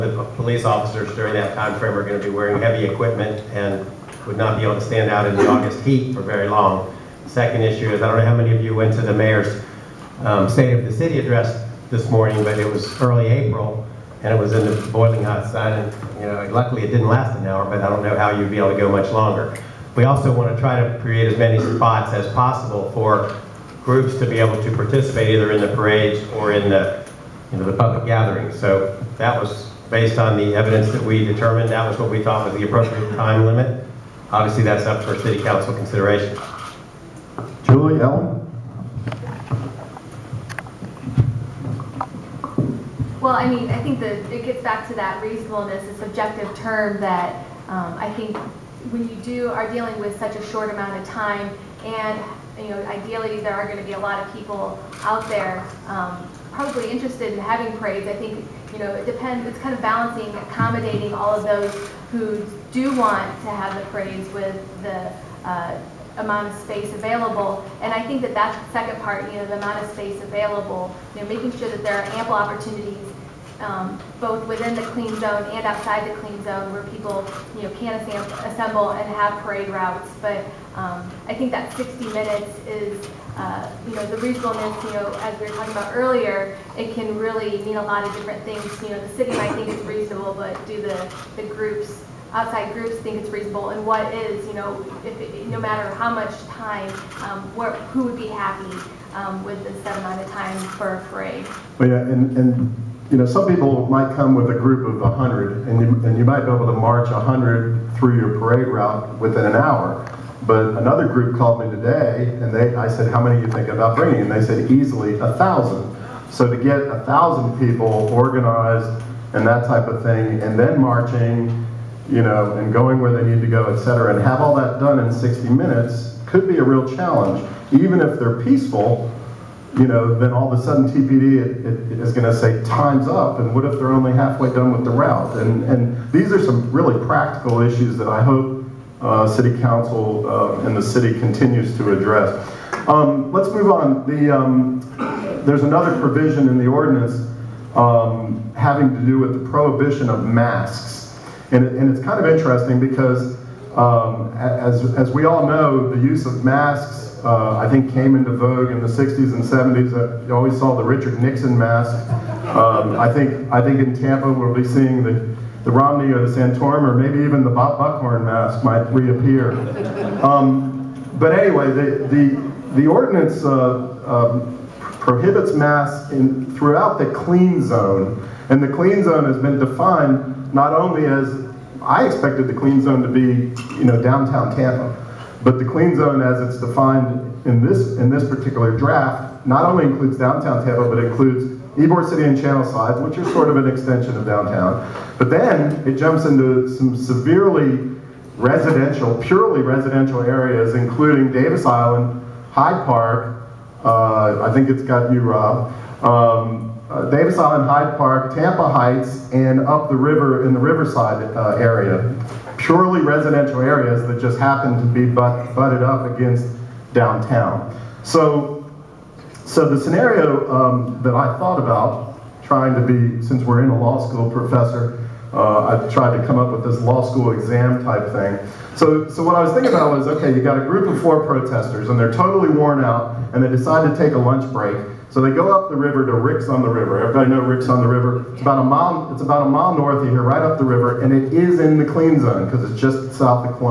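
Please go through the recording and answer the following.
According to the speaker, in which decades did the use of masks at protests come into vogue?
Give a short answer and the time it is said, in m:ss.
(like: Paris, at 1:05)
60s and 70s, at 2:38.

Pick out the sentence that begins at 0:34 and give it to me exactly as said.
Obviously, that's up for city council consideration.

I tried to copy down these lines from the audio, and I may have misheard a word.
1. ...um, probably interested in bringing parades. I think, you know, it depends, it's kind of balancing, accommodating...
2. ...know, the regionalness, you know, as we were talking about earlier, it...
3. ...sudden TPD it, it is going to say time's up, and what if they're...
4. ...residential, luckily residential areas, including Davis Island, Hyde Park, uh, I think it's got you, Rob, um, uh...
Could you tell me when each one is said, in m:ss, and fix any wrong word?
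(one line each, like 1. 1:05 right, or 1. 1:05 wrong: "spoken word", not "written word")
1. 0:55 wrong: "having", not "bringing"
2. 1:23 right
3. 2:10 right
4. 3:18 wrong: "purely", not "luckily".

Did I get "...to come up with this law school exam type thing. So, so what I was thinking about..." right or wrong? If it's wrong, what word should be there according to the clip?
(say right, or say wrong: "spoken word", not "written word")
right.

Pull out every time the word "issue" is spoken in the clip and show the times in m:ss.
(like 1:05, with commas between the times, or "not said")
0:07, 2:17.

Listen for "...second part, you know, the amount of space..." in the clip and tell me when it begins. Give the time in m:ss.
1:08.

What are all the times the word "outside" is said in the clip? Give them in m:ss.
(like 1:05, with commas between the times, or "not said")
1:15, 1:32.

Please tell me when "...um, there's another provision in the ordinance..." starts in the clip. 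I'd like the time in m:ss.
2:24.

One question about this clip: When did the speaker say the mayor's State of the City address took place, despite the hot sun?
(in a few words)
Early April.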